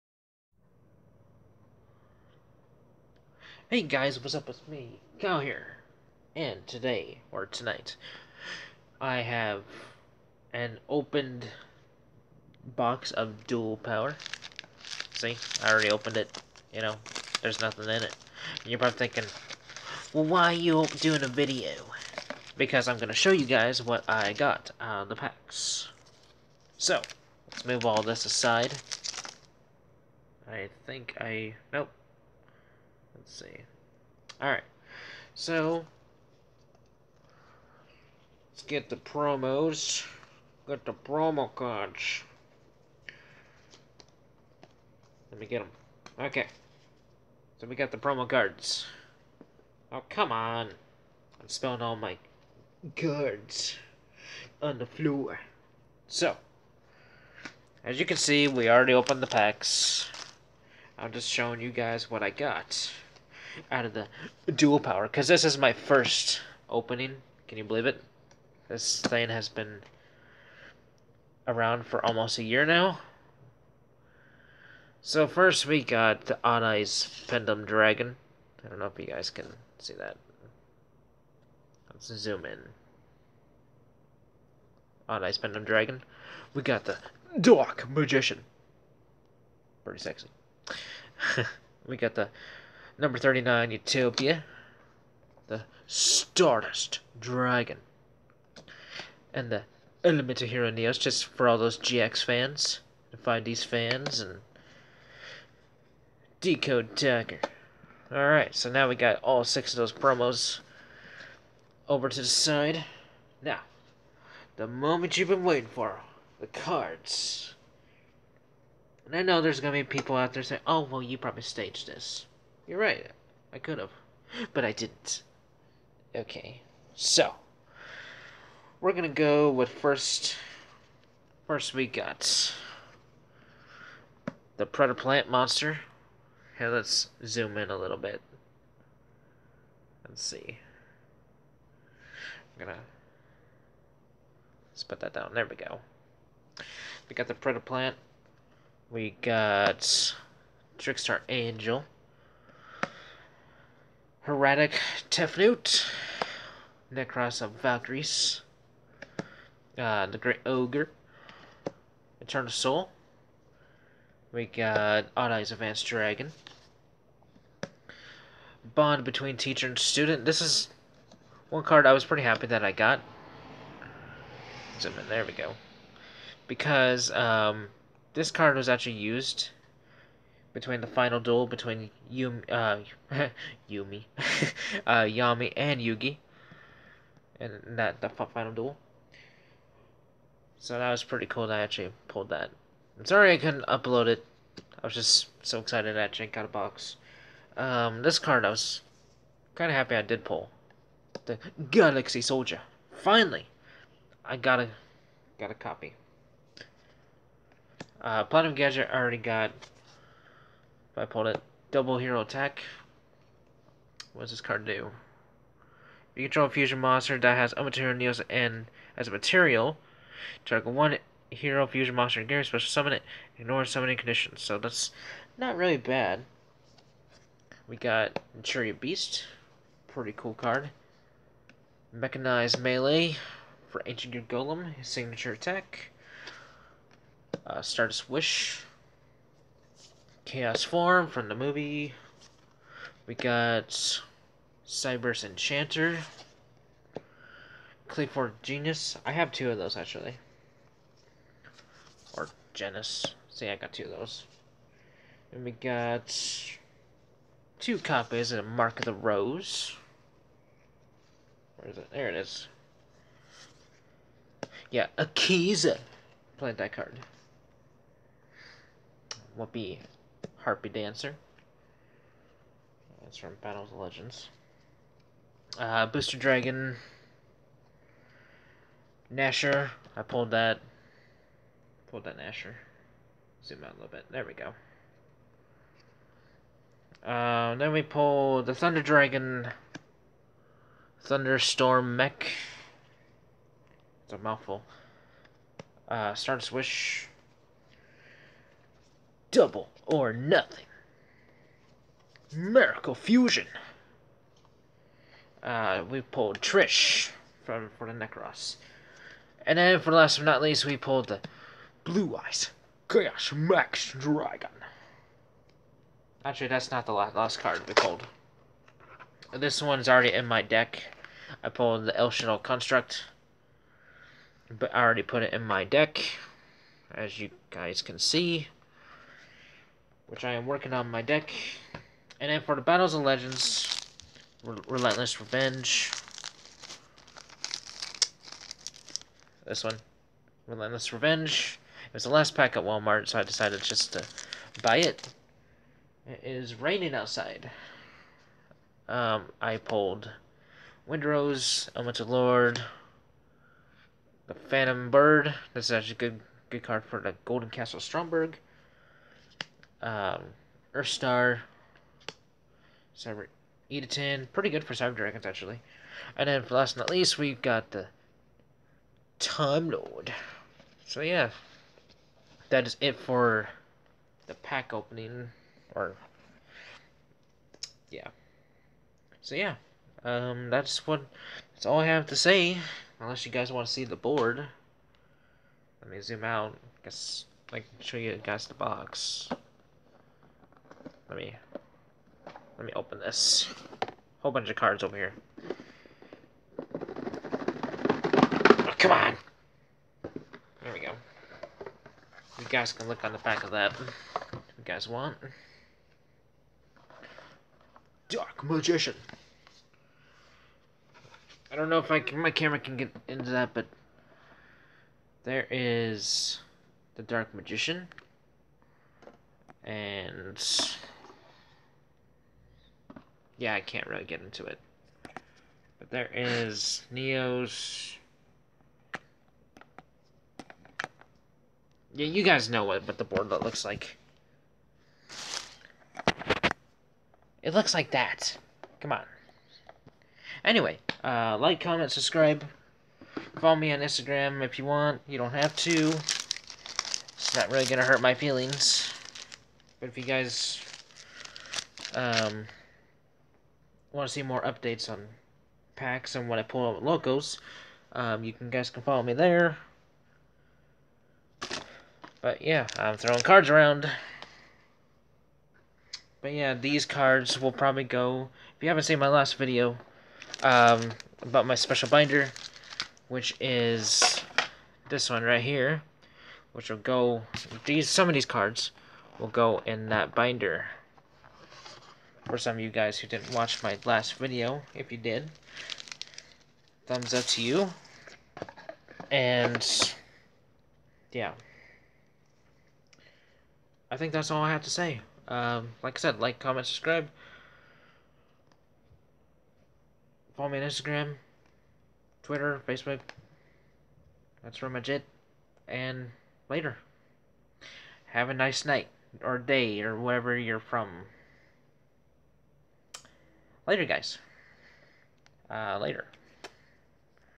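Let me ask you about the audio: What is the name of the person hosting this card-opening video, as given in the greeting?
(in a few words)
Cal.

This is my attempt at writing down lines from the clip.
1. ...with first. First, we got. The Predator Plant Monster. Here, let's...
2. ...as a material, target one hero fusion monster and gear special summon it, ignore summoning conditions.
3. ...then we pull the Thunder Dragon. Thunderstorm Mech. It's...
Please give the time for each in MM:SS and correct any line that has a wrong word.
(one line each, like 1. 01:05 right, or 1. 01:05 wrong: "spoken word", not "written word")
1. 02:09 right
2. 03:38 right
3. 04:47 right.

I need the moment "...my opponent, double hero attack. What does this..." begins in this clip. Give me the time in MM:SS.
03:30.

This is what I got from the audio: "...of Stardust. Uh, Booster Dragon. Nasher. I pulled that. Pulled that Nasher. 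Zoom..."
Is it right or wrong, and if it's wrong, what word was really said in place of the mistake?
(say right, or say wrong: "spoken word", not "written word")
wrong: "Legends", not "Stardust".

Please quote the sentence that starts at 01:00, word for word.
I'm just showing you guys what I got out of the duel power because this is my first opening.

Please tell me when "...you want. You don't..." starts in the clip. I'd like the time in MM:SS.
07:24.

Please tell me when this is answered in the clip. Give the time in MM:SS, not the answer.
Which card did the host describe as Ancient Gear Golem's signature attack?
03:51.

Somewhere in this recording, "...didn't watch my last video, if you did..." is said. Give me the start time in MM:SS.
08:03.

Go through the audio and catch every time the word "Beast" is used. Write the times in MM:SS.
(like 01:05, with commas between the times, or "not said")
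03:48.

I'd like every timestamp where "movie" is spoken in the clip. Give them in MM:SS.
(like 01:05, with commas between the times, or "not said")
04:01.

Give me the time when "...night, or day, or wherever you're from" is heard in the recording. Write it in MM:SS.
08:28.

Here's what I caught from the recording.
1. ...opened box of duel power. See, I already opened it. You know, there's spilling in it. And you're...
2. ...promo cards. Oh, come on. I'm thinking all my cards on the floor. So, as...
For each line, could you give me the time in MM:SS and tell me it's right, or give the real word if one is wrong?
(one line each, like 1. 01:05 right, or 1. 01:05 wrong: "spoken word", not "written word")
1. 00:10 wrong: "nothing", not "spilling"
2. 00:47 wrong: "spilling", not "thinking".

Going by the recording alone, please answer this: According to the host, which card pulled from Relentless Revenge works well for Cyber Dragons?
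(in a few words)
Cyber Edaton.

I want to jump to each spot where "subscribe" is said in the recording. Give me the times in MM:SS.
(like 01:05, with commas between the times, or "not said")
07:21, 08:16.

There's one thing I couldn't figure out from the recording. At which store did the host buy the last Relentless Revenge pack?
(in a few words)
Walmart.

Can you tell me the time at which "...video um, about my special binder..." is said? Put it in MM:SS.
07:49.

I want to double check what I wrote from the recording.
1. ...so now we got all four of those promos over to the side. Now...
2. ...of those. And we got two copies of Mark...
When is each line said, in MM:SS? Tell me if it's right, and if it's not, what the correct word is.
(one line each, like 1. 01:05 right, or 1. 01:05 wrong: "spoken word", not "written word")
1. 01:48 wrong: "six", not "four"
2. 04:13 right.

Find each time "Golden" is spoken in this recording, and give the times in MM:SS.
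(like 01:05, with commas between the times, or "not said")
05:57.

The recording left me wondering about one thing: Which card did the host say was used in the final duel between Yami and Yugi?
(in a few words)
Bond between teacher and student.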